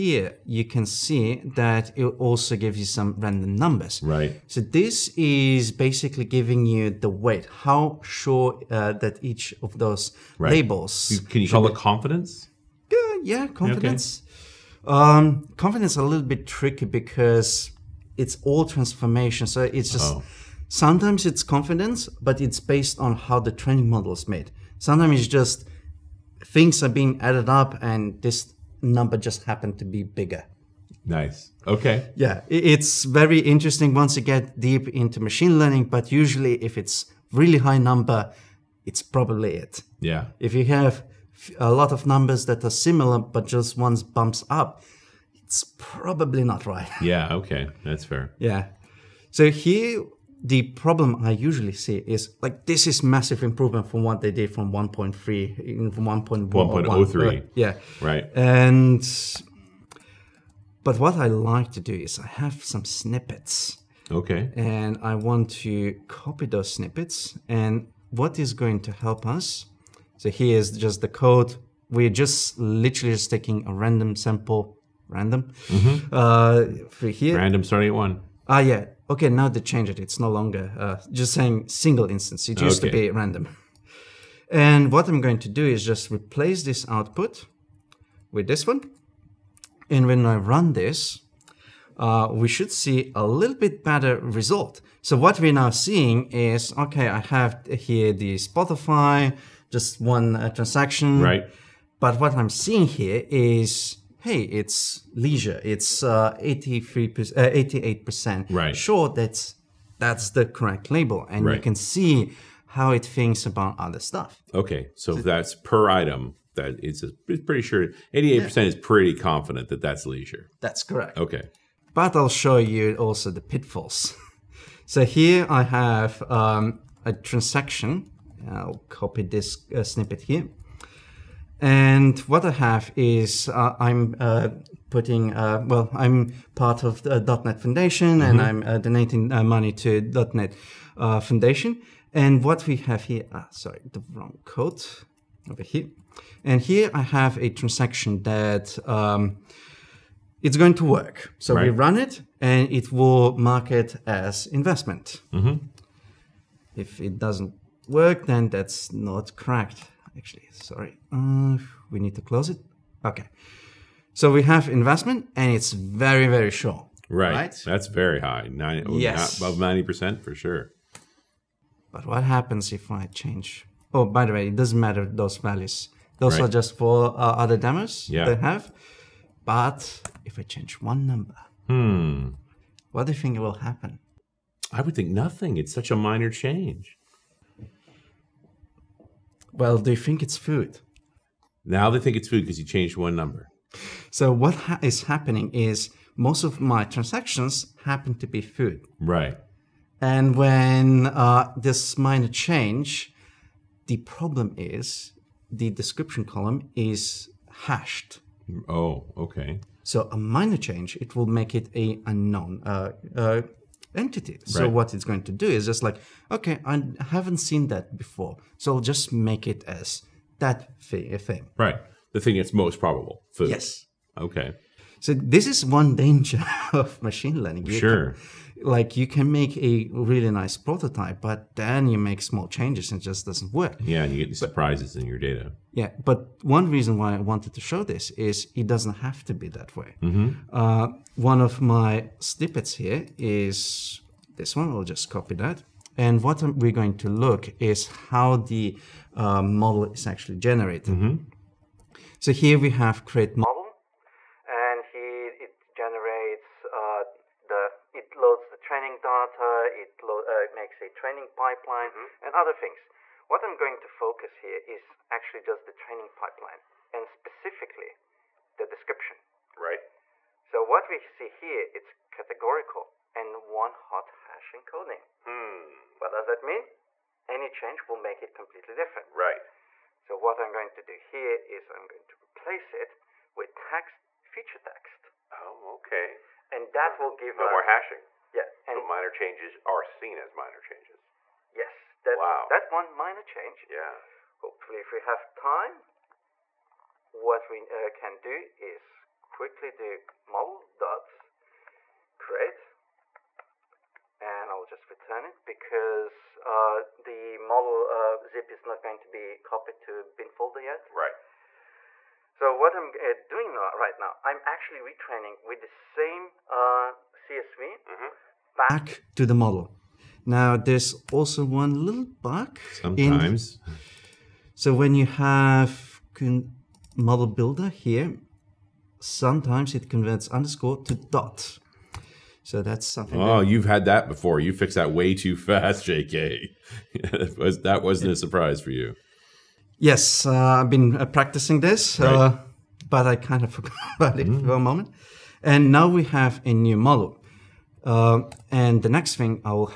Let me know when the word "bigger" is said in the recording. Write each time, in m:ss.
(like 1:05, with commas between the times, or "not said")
0:30.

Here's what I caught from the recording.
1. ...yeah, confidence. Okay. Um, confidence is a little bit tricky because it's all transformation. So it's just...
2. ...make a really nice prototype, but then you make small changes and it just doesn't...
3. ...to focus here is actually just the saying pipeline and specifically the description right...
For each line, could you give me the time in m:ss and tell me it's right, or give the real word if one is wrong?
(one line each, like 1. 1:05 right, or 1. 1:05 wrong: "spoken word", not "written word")
1. 0:13 right
2. 3:49 right
3. 4:23 wrong: "training", not "saying".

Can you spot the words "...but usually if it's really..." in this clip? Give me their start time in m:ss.
0:35.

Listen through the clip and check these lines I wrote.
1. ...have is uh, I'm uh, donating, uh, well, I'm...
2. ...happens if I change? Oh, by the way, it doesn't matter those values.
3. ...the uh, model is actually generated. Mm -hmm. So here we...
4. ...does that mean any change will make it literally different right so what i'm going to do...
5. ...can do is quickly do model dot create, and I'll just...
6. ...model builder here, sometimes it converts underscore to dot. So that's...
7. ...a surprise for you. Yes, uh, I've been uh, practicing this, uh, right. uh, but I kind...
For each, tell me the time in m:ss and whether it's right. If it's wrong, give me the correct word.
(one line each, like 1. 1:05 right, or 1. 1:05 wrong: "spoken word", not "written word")
1. 2:12 wrong: "putting", not "donating"
2. 2:52 right
3. 4:08 right
4. 4:36 wrong: "completely", not "literally"
5. 4:58 right
6. 5:26 right
7. 5:38 right.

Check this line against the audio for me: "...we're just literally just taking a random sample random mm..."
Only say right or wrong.
right.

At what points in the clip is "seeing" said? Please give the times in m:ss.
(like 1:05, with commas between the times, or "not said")
1:35, 1:42.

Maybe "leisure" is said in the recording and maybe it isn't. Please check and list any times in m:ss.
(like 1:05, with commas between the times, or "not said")
1:45, 2:00.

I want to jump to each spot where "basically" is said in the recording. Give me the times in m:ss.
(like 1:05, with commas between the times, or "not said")
0:05.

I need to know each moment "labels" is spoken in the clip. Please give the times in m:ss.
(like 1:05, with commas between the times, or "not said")
0:10, 1:50.